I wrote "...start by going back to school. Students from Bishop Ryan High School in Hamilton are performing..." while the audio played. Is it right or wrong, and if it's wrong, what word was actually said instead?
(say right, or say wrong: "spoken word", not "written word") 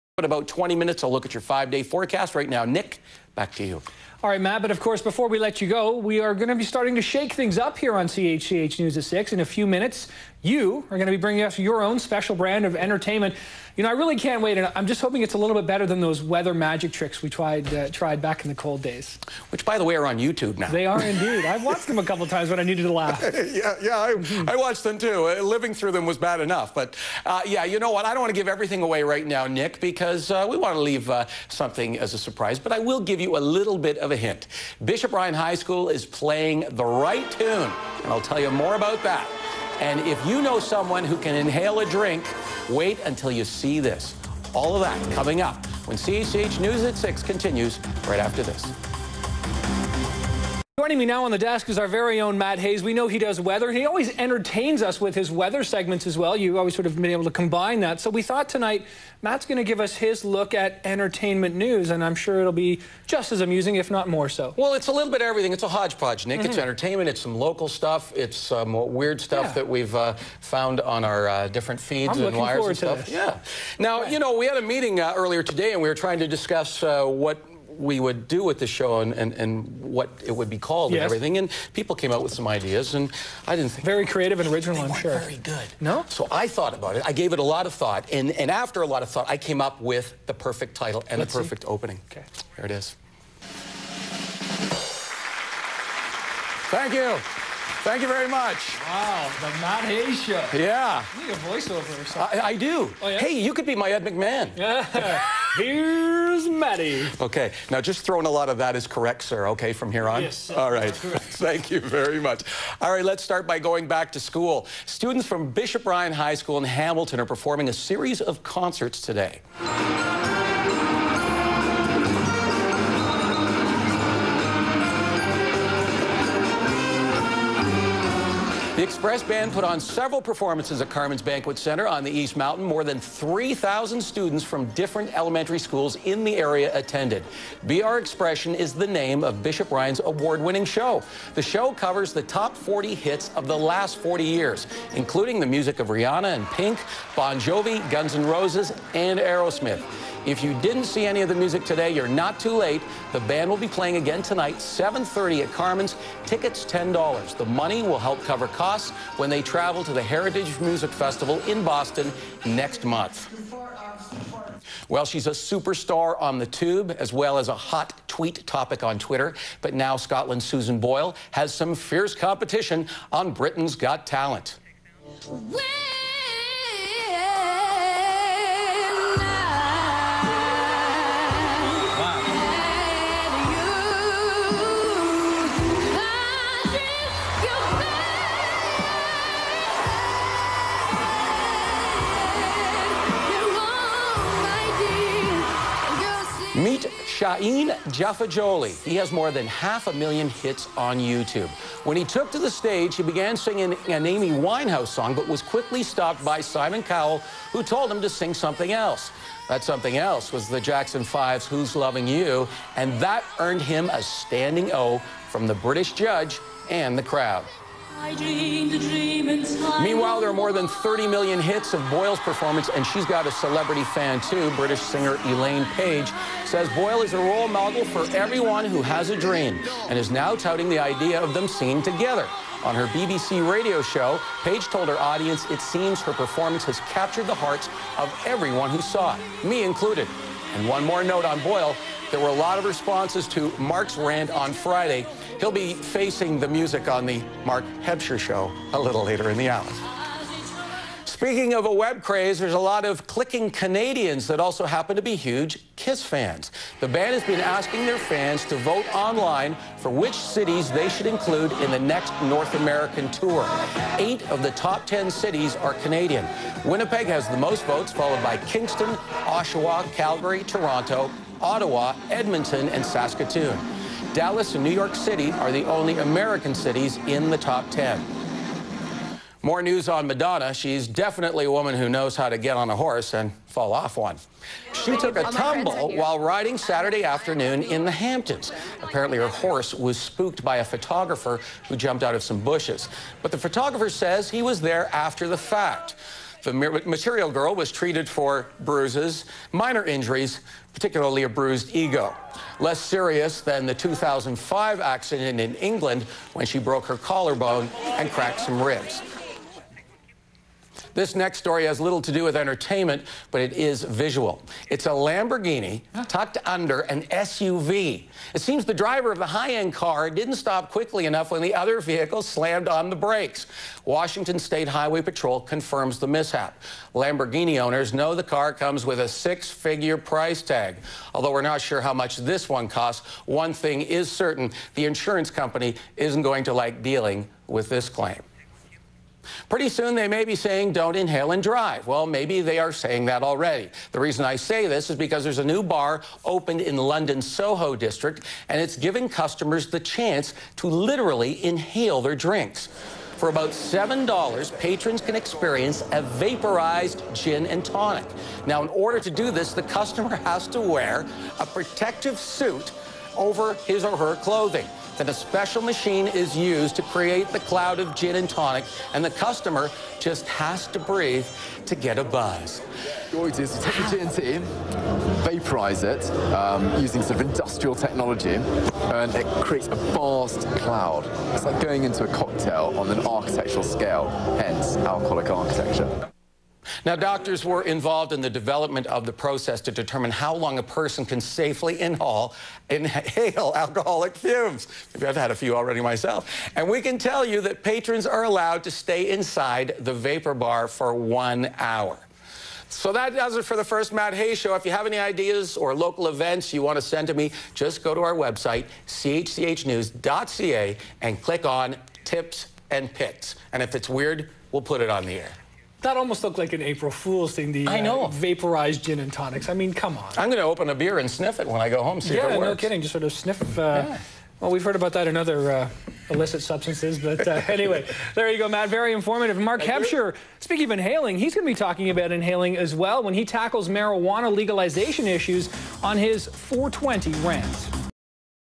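right.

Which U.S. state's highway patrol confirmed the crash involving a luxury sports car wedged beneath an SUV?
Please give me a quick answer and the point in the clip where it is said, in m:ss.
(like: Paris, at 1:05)
Washington, at 5:23.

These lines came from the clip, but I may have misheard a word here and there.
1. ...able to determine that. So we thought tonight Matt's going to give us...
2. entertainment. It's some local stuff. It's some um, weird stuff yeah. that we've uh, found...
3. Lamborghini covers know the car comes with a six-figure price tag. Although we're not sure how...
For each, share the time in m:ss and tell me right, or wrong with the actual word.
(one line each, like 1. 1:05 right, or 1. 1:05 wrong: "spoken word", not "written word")
1. 0:57 wrong: "combine", not "determine"
2. 1:06 right
3. 5:26 wrong: "owners", not "covers".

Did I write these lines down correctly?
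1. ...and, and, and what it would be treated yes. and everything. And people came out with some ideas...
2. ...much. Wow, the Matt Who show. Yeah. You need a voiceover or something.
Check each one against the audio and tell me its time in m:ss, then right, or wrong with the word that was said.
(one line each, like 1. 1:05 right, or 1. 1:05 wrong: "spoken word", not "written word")
1. 1:18 wrong: "called", not "treated"
2. 1:38 wrong: "Hayes", not "Who".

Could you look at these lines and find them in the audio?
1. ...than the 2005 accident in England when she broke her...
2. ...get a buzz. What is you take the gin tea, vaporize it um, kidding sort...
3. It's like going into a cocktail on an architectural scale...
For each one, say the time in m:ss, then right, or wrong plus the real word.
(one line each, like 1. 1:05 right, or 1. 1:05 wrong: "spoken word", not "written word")
1. 5:03 right
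2. 6:11 wrong: "using", not "kidding"
3. 6:21 right.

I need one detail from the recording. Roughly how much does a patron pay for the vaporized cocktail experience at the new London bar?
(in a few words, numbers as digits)
$7.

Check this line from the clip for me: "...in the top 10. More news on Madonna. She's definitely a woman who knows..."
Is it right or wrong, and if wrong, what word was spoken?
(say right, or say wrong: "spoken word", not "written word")
right.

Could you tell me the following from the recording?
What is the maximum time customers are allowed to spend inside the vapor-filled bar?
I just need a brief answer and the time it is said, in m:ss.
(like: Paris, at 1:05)
1 hour, at 6:40.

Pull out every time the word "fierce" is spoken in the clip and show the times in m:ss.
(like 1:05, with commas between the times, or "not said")
2:51.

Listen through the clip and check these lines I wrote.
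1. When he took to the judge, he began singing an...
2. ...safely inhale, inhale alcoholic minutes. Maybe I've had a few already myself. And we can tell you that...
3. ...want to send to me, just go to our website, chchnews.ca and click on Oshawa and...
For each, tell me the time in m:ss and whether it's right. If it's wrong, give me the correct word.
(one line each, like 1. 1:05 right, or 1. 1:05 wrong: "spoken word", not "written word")
1. 3:21 wrong: "stage", not "judge"
2. 6:31 wrong: "fumes", not "minutes"
3. 6:46 wrong: "Tips", not "Oshawa".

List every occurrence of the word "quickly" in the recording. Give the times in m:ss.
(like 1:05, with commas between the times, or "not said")
3:25, 5:20.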